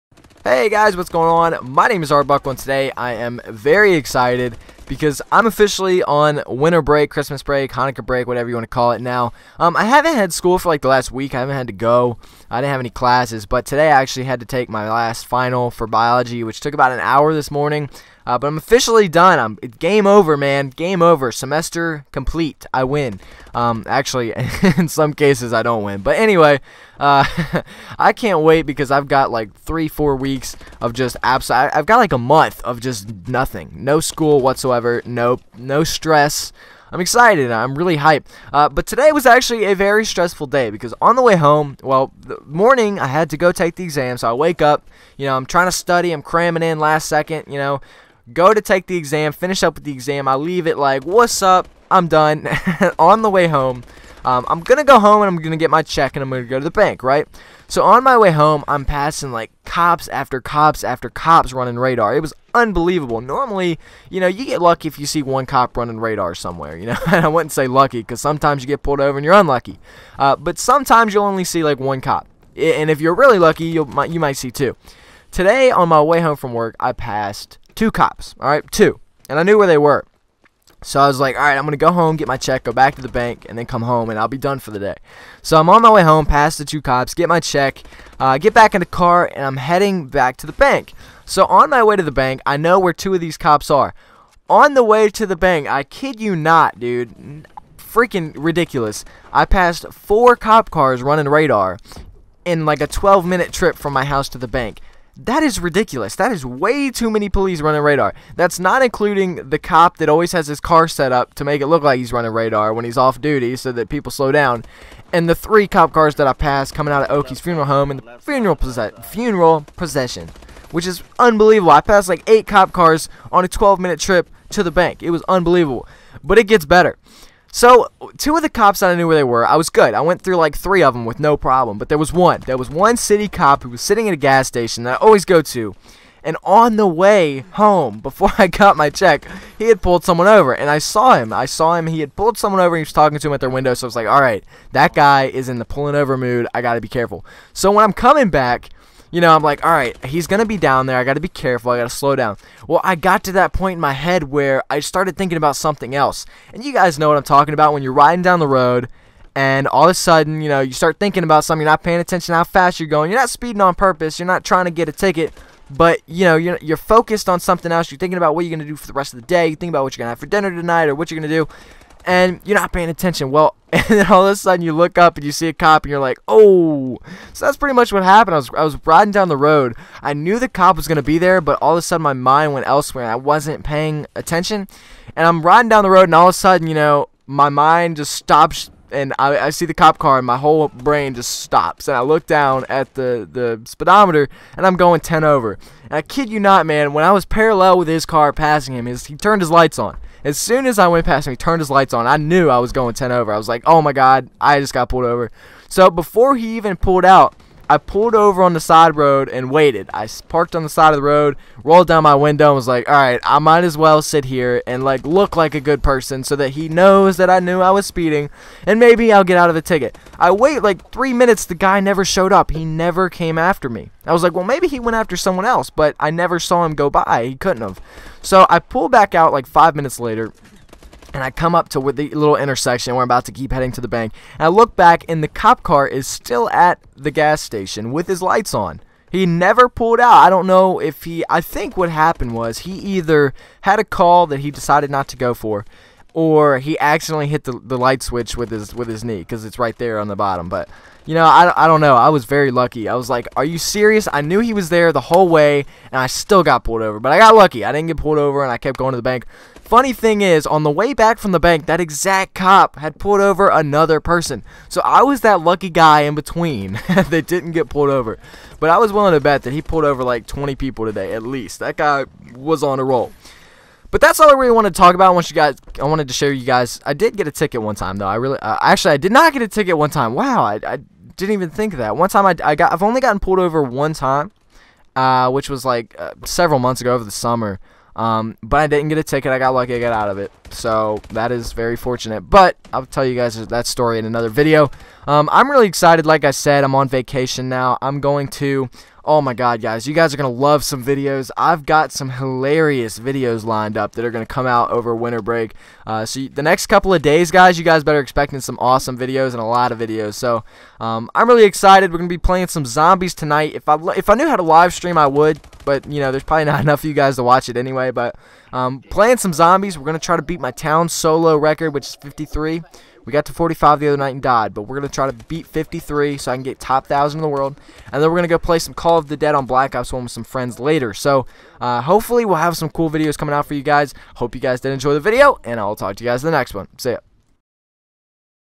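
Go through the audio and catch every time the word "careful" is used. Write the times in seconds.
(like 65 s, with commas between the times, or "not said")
146 s, 151 s.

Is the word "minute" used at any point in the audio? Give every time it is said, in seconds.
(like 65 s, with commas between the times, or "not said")
103 s, 123 s, 221 s, 229 s.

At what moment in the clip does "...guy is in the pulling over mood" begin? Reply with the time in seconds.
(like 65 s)
144 s.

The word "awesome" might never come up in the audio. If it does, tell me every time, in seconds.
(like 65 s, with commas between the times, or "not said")
308 s.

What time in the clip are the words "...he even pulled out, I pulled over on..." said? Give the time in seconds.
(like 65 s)
206 s.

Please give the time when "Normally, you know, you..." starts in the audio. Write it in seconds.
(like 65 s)
63 s.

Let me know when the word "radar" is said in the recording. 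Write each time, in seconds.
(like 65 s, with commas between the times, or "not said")
61 s, 65 s, 101 s, 107 s, 112 s.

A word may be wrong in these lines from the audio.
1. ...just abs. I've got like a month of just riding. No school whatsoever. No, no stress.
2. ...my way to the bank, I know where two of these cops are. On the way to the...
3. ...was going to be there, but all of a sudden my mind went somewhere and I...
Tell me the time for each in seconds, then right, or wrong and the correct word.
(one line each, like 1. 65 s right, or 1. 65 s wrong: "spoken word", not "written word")
1. 30 s wrong: "nothing", not "riding"
2. 91 s right
3. 180 s wrong: "elsewhere", not "somewhere".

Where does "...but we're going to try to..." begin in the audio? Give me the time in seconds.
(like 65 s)
324 s.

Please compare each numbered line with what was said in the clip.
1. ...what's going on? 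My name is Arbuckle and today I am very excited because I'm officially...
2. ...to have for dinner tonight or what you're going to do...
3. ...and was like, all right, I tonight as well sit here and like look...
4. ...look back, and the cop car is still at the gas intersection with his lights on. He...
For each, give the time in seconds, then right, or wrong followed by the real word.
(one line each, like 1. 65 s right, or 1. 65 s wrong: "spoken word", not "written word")
1. 0 s right
2. 170 s right
3. 212 s wrong: "might", not "tonight"
4. 234 s wrong: "station", not "intersection".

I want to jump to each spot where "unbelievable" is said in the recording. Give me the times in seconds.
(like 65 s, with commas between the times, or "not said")
62 s, 121 s, 125 s.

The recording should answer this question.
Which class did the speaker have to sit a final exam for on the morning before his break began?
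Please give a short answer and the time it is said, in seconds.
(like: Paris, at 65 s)
biology, at 15 s.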